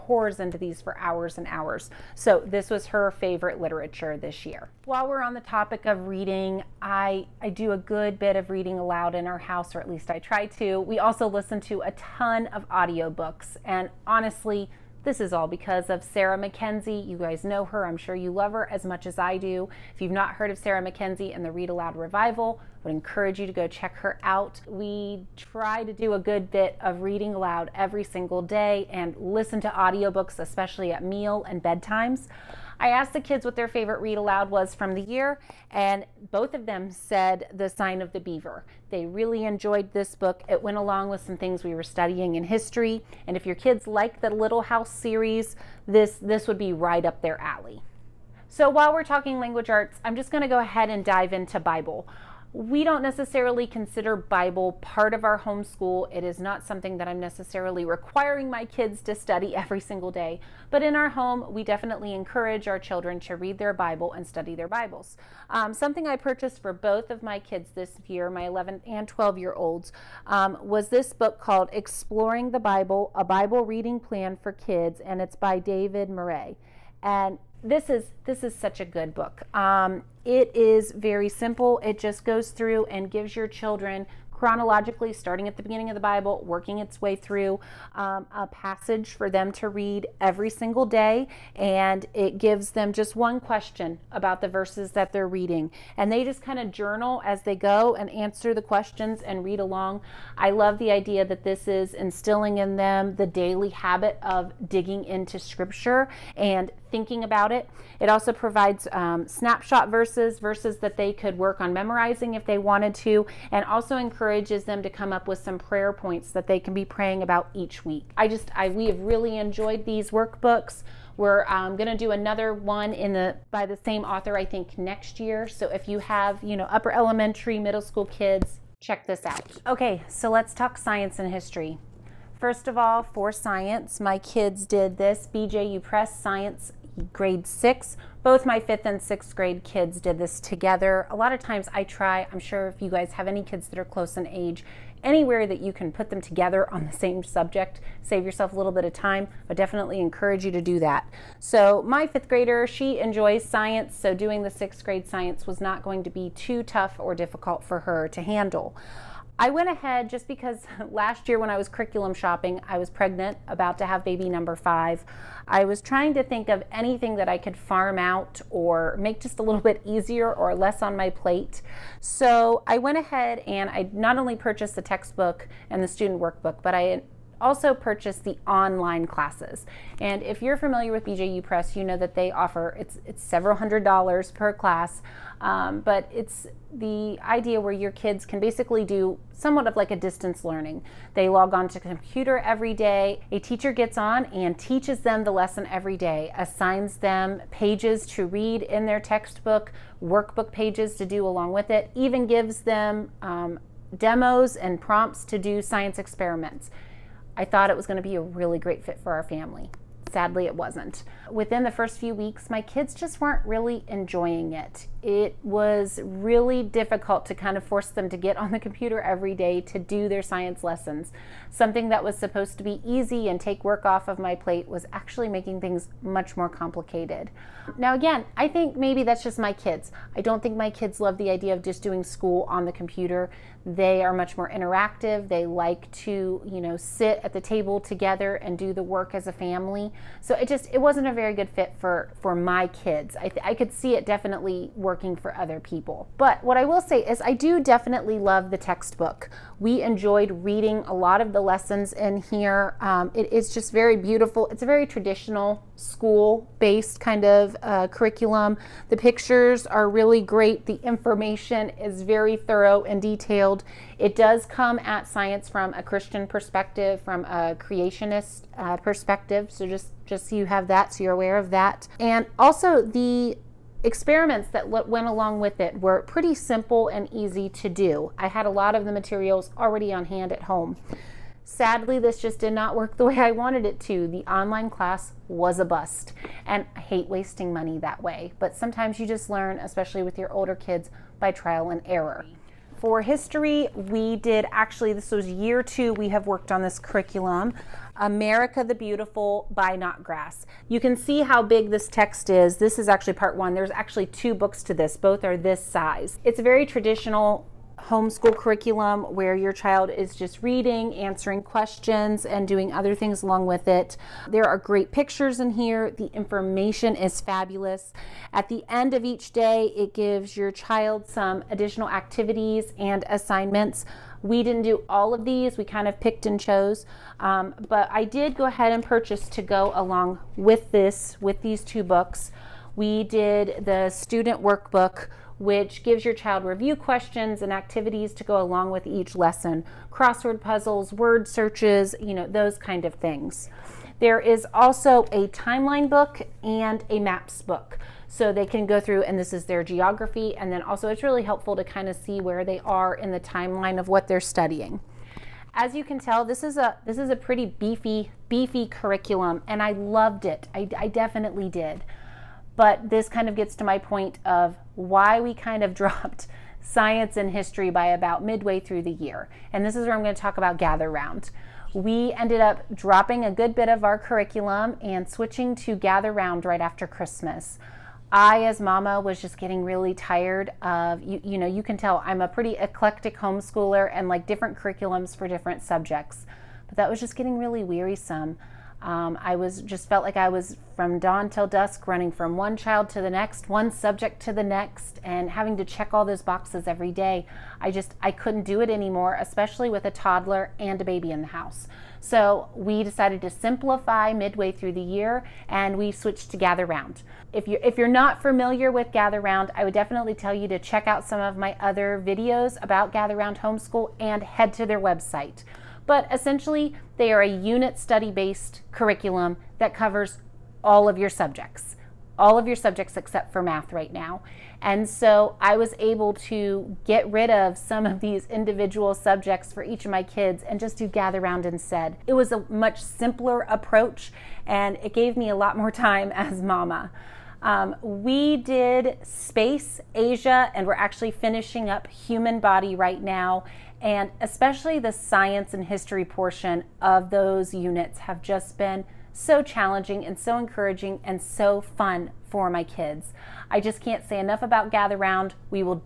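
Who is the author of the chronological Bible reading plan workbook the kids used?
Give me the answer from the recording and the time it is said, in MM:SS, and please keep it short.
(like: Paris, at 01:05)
David Murray, at 01:15.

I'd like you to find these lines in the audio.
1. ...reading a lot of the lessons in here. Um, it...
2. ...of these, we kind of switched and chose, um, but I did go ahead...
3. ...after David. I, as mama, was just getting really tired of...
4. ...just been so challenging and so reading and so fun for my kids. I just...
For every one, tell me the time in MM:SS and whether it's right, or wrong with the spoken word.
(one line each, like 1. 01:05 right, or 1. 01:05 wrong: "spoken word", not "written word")
1. 04:10 right
2. 05:25 wrong: "picked", not "switched"
3. 06:16 wrong: "Christmas", not "David"
4. 07:28 wrong: "encouraging", not "reading".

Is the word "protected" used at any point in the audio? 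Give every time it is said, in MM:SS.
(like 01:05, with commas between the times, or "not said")
not said.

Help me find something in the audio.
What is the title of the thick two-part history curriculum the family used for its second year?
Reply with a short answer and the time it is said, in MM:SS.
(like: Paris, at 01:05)
America the Beautiful, at 04:57.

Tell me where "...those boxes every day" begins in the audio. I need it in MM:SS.
06:36.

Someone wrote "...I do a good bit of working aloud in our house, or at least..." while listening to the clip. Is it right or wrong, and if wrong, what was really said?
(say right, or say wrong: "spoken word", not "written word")
wrong: "reading", not "working".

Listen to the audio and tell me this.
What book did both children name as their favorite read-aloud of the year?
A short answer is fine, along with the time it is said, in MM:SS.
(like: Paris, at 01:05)
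The Sign of the Beaver, at 00:37.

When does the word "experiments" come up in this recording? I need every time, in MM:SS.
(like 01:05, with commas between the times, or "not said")
03:25, 04:33.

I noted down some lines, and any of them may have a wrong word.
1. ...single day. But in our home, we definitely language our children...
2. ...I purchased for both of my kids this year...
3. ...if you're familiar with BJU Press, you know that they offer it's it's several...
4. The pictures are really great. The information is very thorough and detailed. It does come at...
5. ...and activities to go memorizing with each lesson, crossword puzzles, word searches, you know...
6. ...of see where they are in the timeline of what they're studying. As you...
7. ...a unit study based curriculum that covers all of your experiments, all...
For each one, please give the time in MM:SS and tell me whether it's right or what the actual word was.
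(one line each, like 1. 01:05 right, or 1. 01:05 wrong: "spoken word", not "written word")
1. 00:59 wrong: "encourage", not "language"
2. 01:06 right
3. 03:00 right
4. 04:18 right
5. 05:37 wrong: "along", not "memorizing"
6. 05:51 right
7. 06:57 wrong: "subjects", not "experiments".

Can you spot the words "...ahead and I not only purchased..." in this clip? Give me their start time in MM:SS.
02:52.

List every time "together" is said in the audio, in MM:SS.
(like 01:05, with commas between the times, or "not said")
02:20, 02:26, 03:57.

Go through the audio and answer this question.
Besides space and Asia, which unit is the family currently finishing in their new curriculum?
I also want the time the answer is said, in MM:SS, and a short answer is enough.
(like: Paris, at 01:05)
human body, at 07:21.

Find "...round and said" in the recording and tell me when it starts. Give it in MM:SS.
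07:11.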